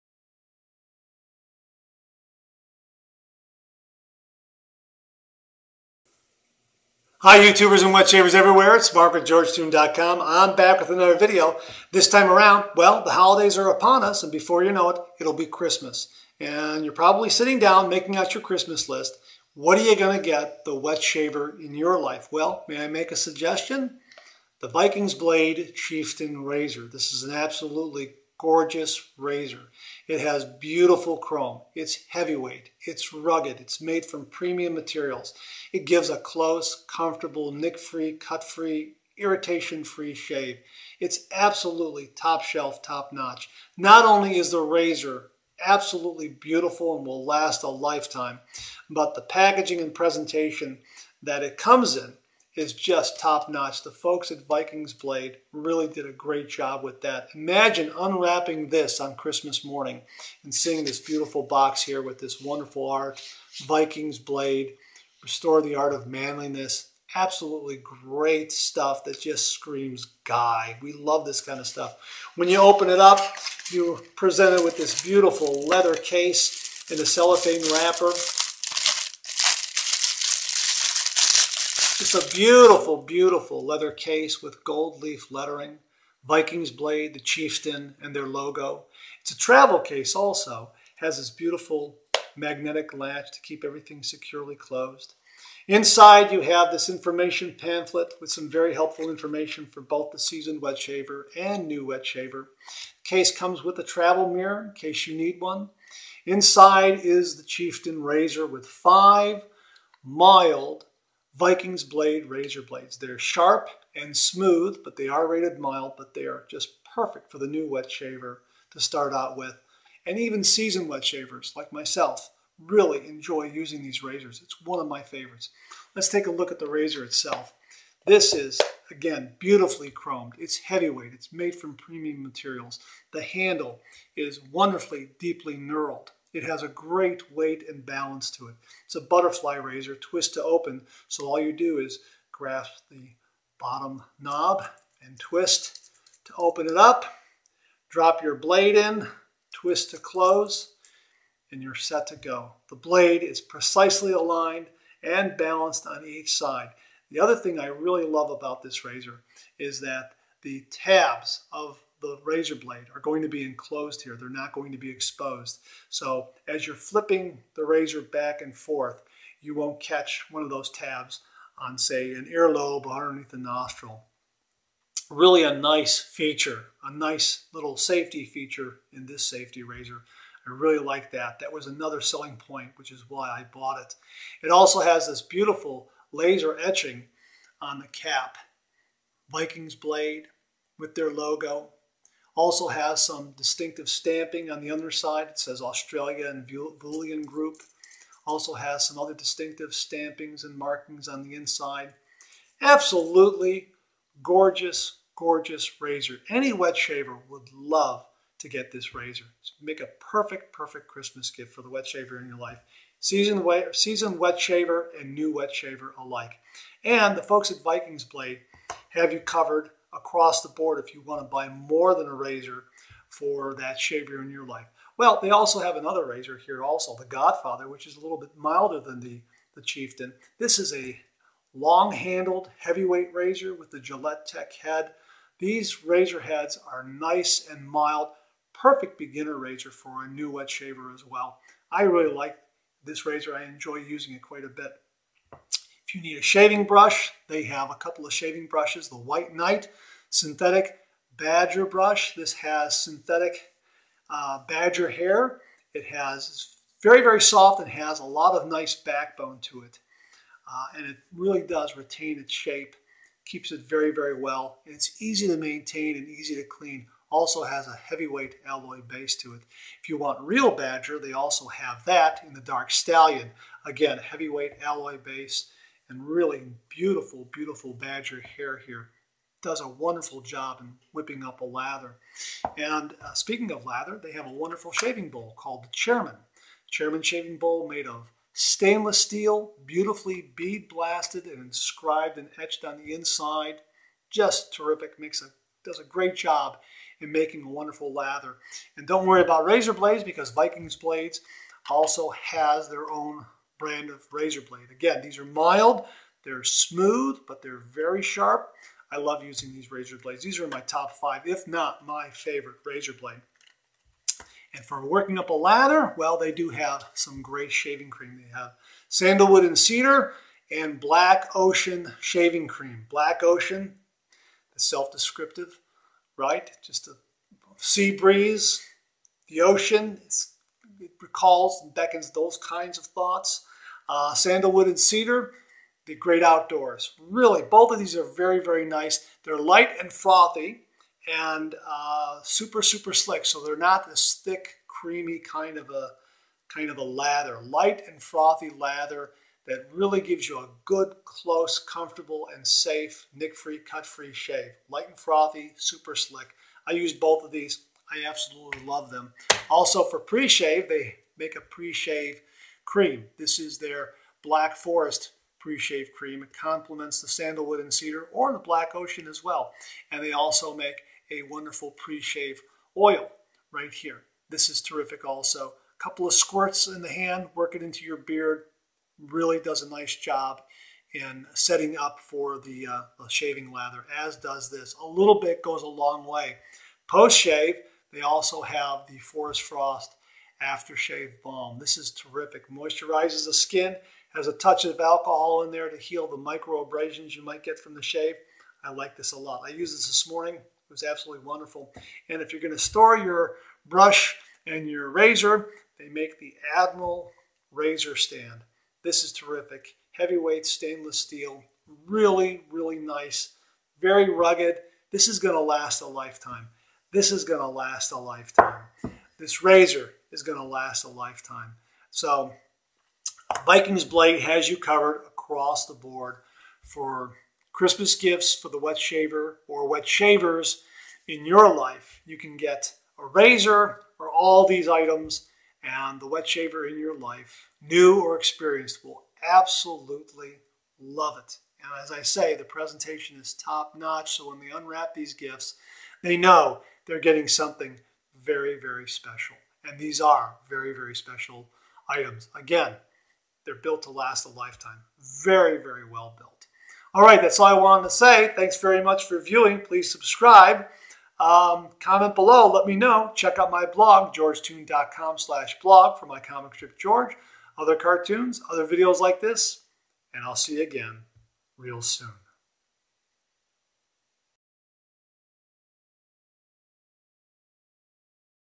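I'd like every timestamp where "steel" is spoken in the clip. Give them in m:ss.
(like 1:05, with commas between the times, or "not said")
4:48, 6:50.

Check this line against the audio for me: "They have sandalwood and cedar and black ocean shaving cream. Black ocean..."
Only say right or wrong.
right.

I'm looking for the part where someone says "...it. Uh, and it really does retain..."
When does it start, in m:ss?
4:19.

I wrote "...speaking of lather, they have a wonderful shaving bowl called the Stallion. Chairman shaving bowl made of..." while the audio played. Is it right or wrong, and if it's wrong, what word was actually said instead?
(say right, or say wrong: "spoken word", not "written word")
wrong: "Chairman", not "Stallion".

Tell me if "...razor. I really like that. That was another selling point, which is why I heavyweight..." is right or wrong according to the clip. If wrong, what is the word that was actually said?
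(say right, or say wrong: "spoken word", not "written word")
wrong: "bought", not "heavyweight".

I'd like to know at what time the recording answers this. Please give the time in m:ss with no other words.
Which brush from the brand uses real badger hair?
4:32.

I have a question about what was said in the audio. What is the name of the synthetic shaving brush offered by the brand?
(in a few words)
White Knight.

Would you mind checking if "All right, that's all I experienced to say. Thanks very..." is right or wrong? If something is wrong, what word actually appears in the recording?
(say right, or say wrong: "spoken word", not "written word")
wrong: "wanted", not "experienced".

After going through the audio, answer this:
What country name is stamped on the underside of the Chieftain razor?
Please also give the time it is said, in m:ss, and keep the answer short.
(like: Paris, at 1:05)
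Australia, at 3:15.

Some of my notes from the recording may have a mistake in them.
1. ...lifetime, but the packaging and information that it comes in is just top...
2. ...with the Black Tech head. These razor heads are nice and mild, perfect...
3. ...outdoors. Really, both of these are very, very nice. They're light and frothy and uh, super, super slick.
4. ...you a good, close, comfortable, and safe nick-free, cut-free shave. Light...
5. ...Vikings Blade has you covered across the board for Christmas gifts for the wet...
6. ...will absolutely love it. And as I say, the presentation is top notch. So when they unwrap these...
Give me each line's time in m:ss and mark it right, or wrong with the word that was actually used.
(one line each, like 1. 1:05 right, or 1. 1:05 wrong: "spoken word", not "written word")
1. 0:47 wrong: "presentation", not "information"
2. 3:53 wrong: "Gillette", not "Black"
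3. 5:36 right
4. 5:50 right
5. 7:03 right
6. 7:18 right.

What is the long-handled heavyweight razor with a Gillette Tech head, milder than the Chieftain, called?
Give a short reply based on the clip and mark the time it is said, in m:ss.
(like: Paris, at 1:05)
The Godfather, at 3:46.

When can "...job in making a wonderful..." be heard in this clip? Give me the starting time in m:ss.
4:56.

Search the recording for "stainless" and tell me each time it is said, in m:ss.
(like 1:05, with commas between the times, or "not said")
4:48, 6:50.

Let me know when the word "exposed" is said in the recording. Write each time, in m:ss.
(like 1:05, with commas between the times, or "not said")
2:44.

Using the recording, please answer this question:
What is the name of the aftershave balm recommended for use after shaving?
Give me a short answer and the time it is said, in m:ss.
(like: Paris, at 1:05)
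Forest Frost, at 6:28.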